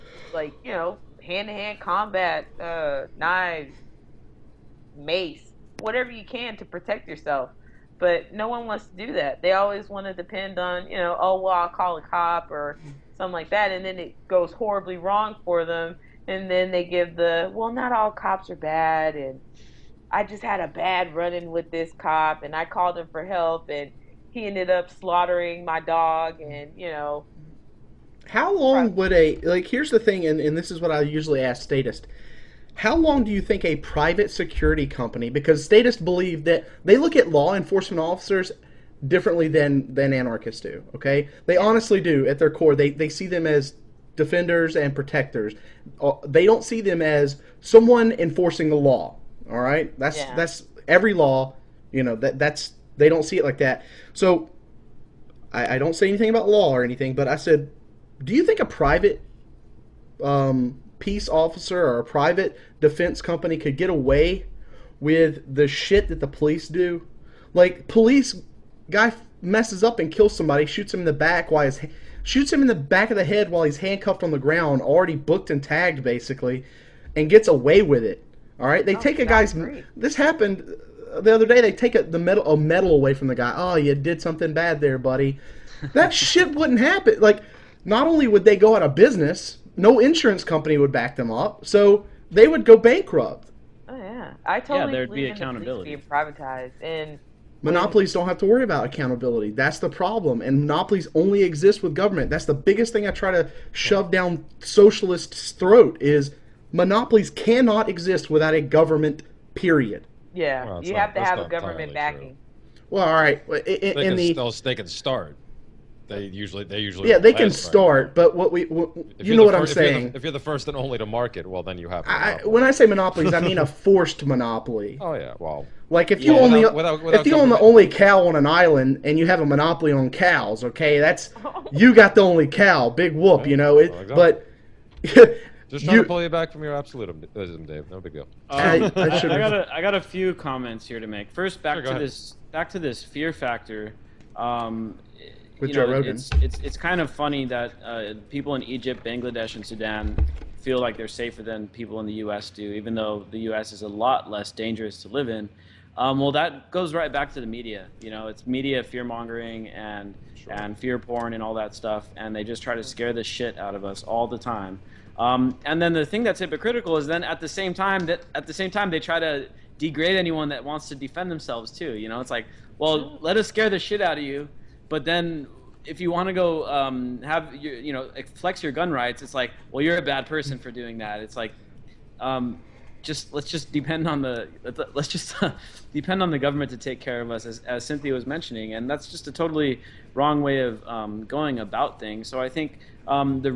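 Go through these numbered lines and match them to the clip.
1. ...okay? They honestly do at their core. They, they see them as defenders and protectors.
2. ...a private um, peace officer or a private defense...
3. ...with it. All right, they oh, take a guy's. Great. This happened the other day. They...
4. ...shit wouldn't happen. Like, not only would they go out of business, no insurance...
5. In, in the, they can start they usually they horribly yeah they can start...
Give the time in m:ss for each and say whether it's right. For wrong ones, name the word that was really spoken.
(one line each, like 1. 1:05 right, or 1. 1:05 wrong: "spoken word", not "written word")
1. 0:40 right
2. 0:58 right
3. 1:17 right
4. 1:26 right
5. 1:53 wrong: "usually", not "horribly".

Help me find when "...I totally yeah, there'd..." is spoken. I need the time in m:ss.
1:34.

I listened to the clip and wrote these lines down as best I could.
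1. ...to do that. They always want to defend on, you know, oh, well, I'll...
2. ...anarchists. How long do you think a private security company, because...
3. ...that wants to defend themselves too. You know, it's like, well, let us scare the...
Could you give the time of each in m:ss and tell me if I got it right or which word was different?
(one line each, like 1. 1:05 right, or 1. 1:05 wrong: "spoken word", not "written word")
1. 0:08 wrong: "depend", not "defend"
2. 0:31 wrong: "statists", not "anarchists"
3. 2:50 right.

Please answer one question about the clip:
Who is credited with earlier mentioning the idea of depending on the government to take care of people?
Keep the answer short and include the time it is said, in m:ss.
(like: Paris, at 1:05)
Cynthia, at 3:07.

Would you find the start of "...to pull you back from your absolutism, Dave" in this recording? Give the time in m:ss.
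2:16.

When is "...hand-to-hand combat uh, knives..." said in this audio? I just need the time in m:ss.
0:01.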